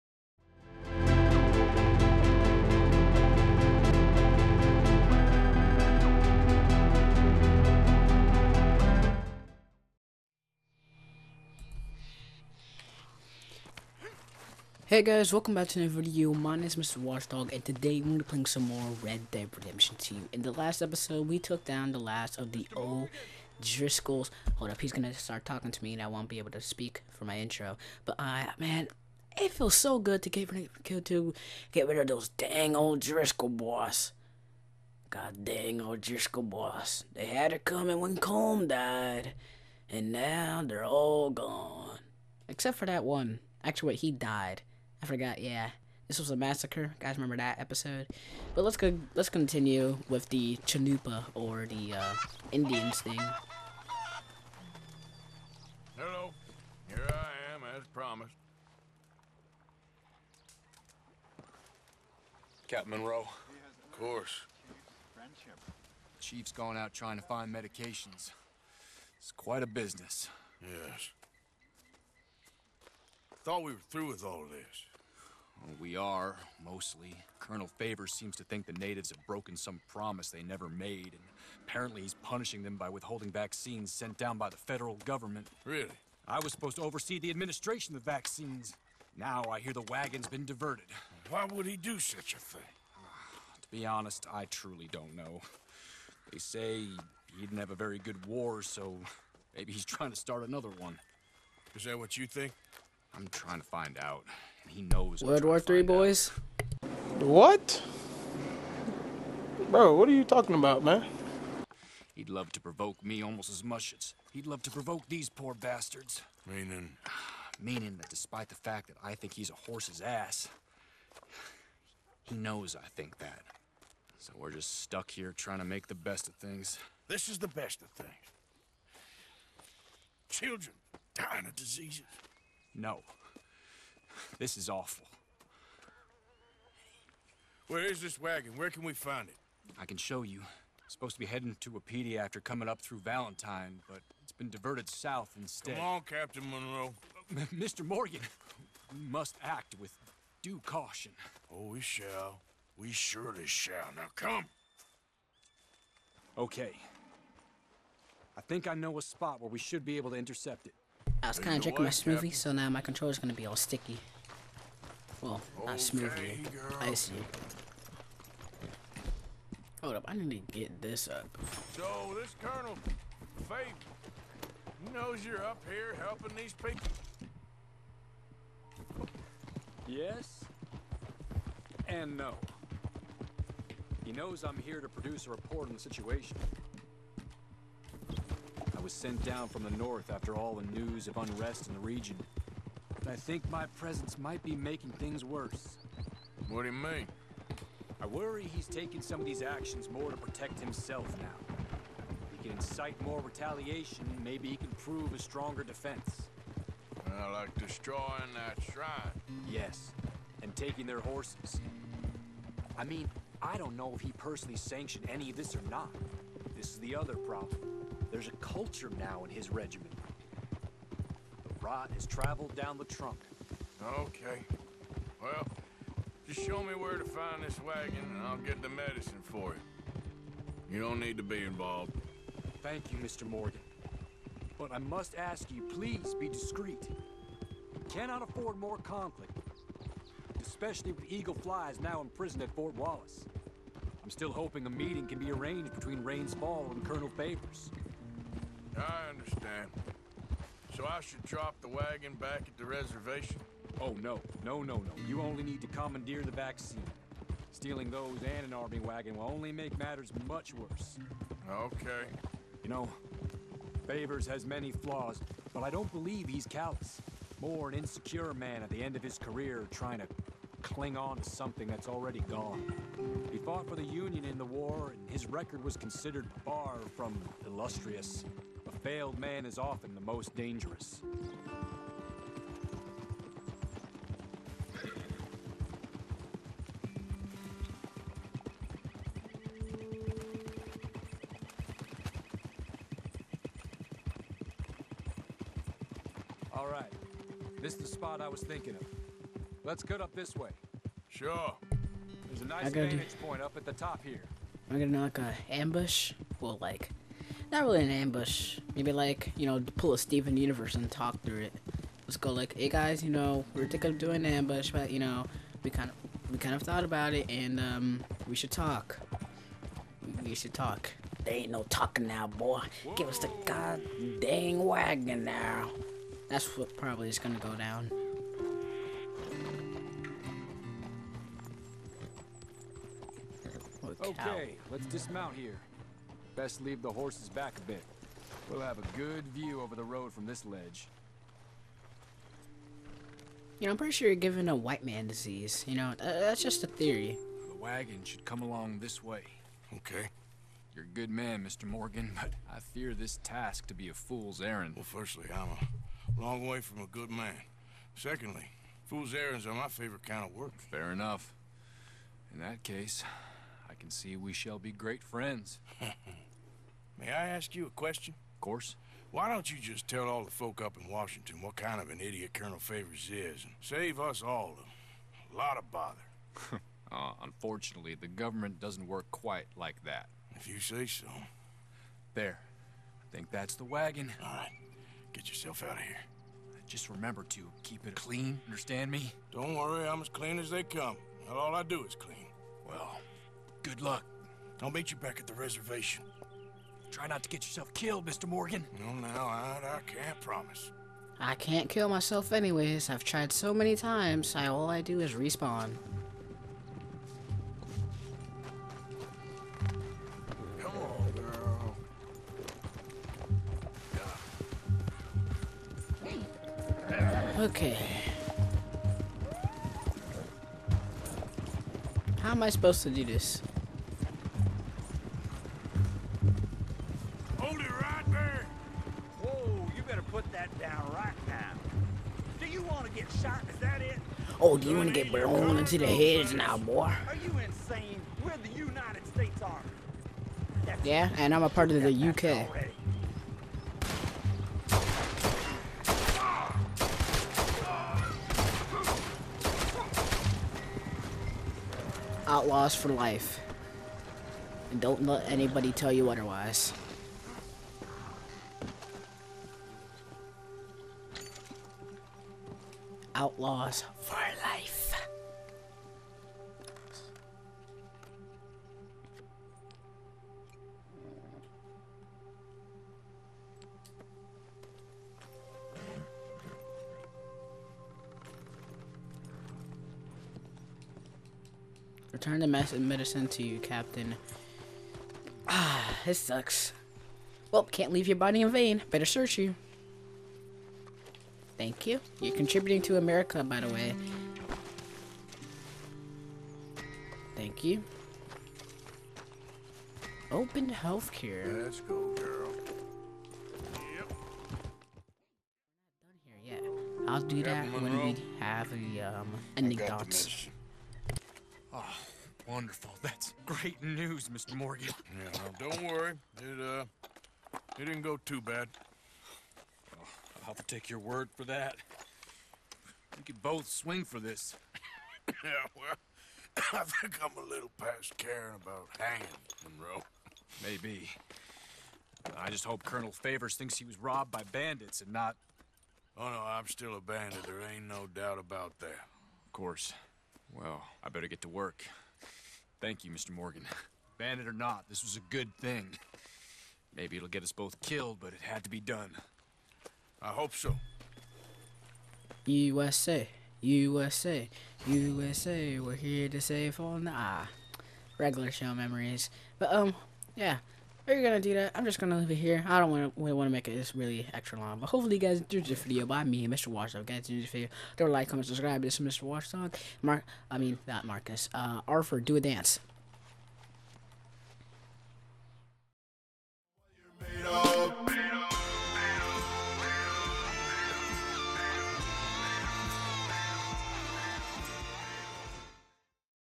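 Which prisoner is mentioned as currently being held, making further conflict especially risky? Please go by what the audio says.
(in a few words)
Eagle Flies.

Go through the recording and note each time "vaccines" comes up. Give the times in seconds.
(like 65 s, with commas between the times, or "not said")
83 s, 88 s, 256 s.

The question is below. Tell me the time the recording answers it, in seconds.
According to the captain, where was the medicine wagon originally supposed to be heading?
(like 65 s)
141 s.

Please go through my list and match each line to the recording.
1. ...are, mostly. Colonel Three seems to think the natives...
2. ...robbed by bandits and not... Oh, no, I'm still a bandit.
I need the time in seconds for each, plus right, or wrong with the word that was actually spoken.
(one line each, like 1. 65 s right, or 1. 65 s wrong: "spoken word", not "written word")
1. 75 s wrong: "Favours", not "Three"
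2. 533 s right.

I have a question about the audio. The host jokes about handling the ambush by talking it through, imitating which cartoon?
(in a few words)
Steven Universe.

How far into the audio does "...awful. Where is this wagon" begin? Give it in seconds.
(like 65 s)
134 s.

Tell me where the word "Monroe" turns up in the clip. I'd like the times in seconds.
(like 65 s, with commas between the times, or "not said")
62 s, 146 s, 529 s.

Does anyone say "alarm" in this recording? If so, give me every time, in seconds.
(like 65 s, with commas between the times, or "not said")
not said.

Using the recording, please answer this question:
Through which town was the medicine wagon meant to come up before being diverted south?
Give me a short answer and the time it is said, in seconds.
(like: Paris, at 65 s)
Valentine, at 142 s.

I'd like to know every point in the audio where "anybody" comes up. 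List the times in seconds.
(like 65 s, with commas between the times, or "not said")
455 s.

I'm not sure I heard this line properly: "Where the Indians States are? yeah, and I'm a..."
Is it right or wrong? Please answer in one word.
wrong.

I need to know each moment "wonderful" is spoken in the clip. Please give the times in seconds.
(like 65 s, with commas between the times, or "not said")
512 s.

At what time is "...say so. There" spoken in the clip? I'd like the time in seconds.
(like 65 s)
380 s.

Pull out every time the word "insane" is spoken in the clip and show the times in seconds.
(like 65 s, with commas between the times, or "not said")
437 s.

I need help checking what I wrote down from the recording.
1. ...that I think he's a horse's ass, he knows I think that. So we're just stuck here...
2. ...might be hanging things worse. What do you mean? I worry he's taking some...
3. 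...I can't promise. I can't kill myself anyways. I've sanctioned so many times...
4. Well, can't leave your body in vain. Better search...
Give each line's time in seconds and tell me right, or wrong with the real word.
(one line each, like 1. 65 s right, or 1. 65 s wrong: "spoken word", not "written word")
1. 118 s right
2. 194 s wrong: "making", not "hanging"
3. 399 s wrong: "tried", not "sanctioned"
4. 487 s right.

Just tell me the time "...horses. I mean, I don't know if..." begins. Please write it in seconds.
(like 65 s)
211 s.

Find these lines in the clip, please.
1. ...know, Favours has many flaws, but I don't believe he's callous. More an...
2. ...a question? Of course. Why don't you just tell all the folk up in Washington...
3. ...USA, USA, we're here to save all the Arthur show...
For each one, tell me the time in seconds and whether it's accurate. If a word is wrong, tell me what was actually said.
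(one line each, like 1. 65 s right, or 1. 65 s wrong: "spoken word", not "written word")
1. 262 s right
2. 367 s right
3. 553 s wrong: "Regular", not "Arthur".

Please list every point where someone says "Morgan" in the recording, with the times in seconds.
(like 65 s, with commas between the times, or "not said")
147 s, 233 s, 351 s, 398 s, 514 s, 543 s.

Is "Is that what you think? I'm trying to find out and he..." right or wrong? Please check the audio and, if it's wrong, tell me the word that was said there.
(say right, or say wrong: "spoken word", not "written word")
right.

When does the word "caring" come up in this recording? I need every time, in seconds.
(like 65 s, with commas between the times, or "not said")
528 s.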